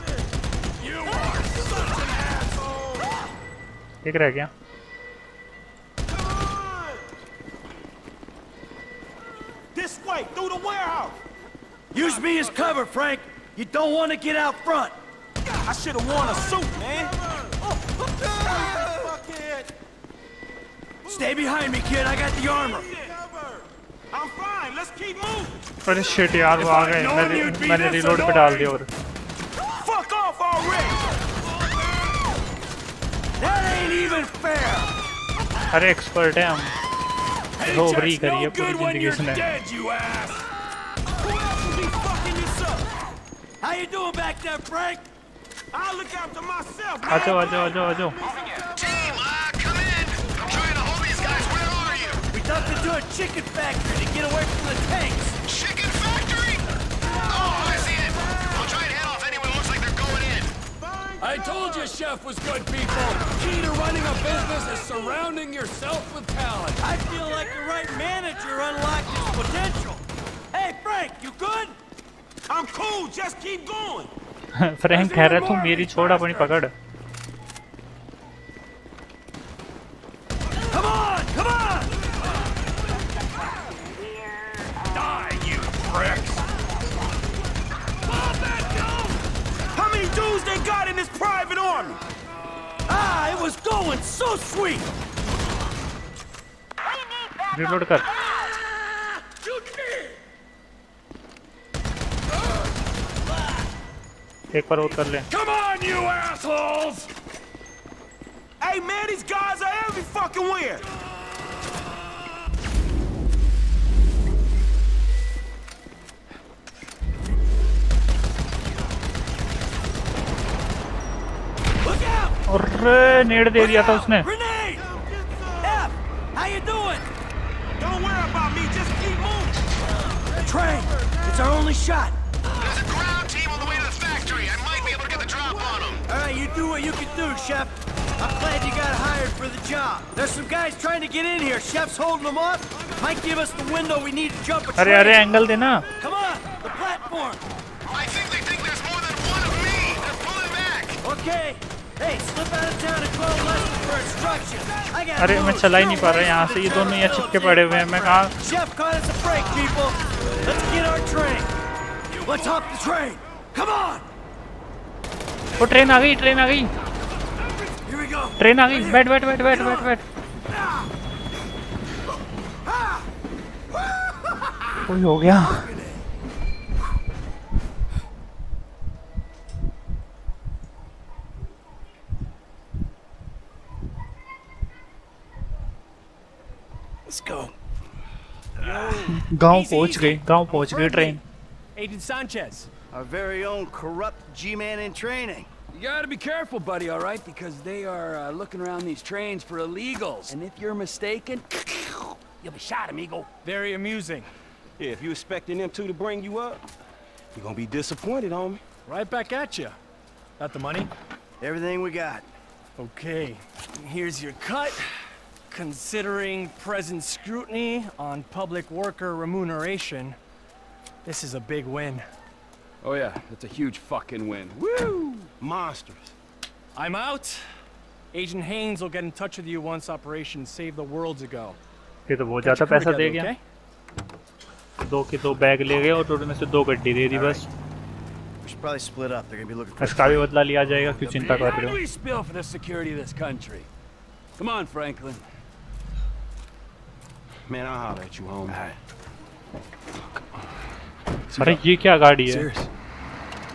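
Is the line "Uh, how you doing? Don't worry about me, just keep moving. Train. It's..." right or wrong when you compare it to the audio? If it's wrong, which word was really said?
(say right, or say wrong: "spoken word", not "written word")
right.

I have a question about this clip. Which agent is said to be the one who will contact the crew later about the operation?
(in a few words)
Agent Haines.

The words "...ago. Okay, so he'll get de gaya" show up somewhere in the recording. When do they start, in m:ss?
3:51.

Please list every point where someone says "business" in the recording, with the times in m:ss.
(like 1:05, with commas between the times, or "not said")
1:04.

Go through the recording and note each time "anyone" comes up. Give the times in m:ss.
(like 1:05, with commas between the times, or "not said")
0:59.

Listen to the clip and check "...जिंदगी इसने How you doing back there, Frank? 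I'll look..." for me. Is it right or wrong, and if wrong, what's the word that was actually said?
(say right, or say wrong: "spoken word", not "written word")
right.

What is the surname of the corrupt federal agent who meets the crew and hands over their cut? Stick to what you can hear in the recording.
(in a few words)
Sanchez.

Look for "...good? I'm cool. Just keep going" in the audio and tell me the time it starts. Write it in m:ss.
1:11.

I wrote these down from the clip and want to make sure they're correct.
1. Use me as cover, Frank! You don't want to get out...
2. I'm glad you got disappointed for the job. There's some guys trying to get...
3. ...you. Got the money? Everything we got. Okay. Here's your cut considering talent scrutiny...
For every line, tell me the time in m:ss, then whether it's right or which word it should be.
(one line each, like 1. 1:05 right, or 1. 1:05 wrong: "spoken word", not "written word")
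1. 0:11 right
2. 2:18 wrong: "hired", not "disappointed"
3. 3:29 wrong: "present", not "talent".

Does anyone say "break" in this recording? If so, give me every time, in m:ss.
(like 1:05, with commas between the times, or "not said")
not said.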